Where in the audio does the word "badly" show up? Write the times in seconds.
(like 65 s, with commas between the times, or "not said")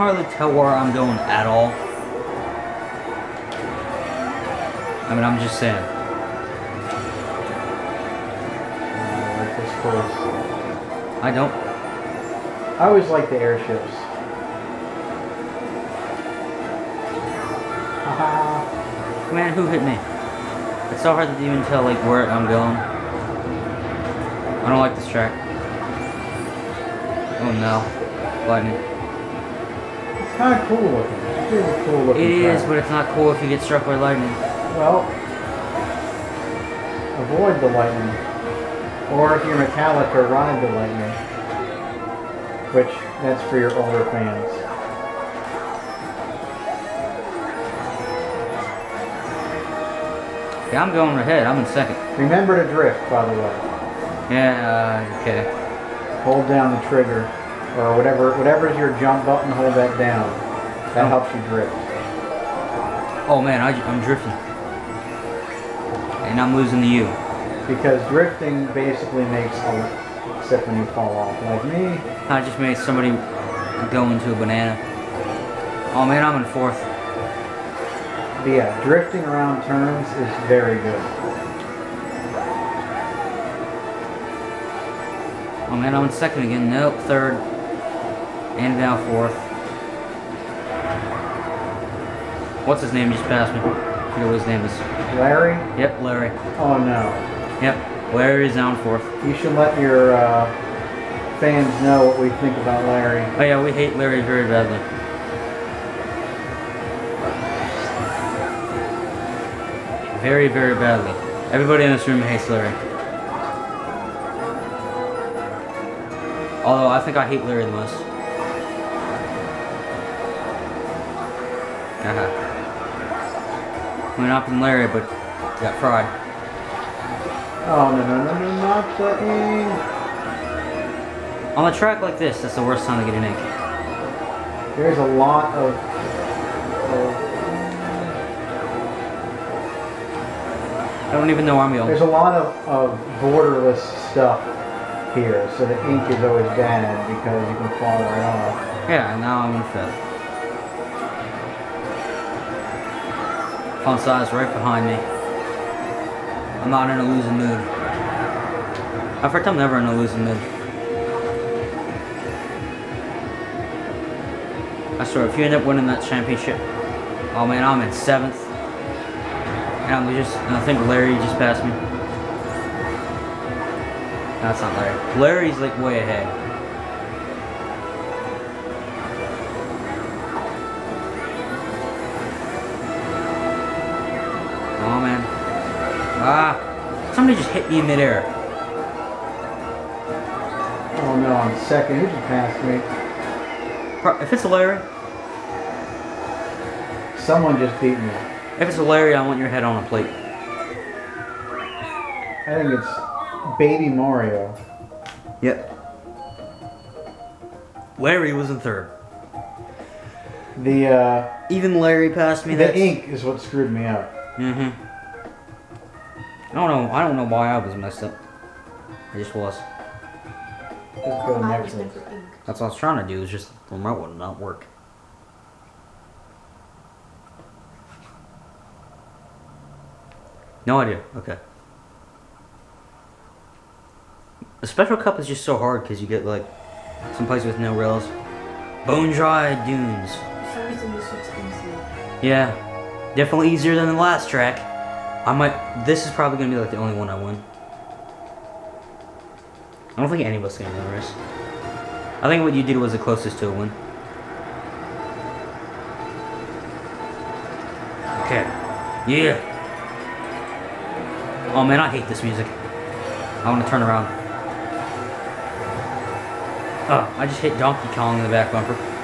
104 s, 110 s.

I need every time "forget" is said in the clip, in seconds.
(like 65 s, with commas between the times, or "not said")
94 s.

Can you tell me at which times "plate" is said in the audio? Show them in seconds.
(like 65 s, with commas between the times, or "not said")
199 s.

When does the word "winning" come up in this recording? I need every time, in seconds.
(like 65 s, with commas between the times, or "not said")
165 s.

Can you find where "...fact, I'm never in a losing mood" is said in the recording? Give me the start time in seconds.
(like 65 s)
159 s.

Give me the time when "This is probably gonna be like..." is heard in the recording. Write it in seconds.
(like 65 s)
245 s.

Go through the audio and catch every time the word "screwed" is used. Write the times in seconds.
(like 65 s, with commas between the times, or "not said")
213 s.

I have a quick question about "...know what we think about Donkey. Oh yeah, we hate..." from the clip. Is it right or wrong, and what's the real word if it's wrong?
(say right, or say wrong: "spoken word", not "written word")
wrong: "Larry", not "Donkey".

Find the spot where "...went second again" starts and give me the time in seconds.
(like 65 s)
86 s.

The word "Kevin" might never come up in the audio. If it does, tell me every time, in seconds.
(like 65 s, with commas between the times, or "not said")
not said.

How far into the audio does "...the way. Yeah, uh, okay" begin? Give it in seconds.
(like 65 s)
53 s.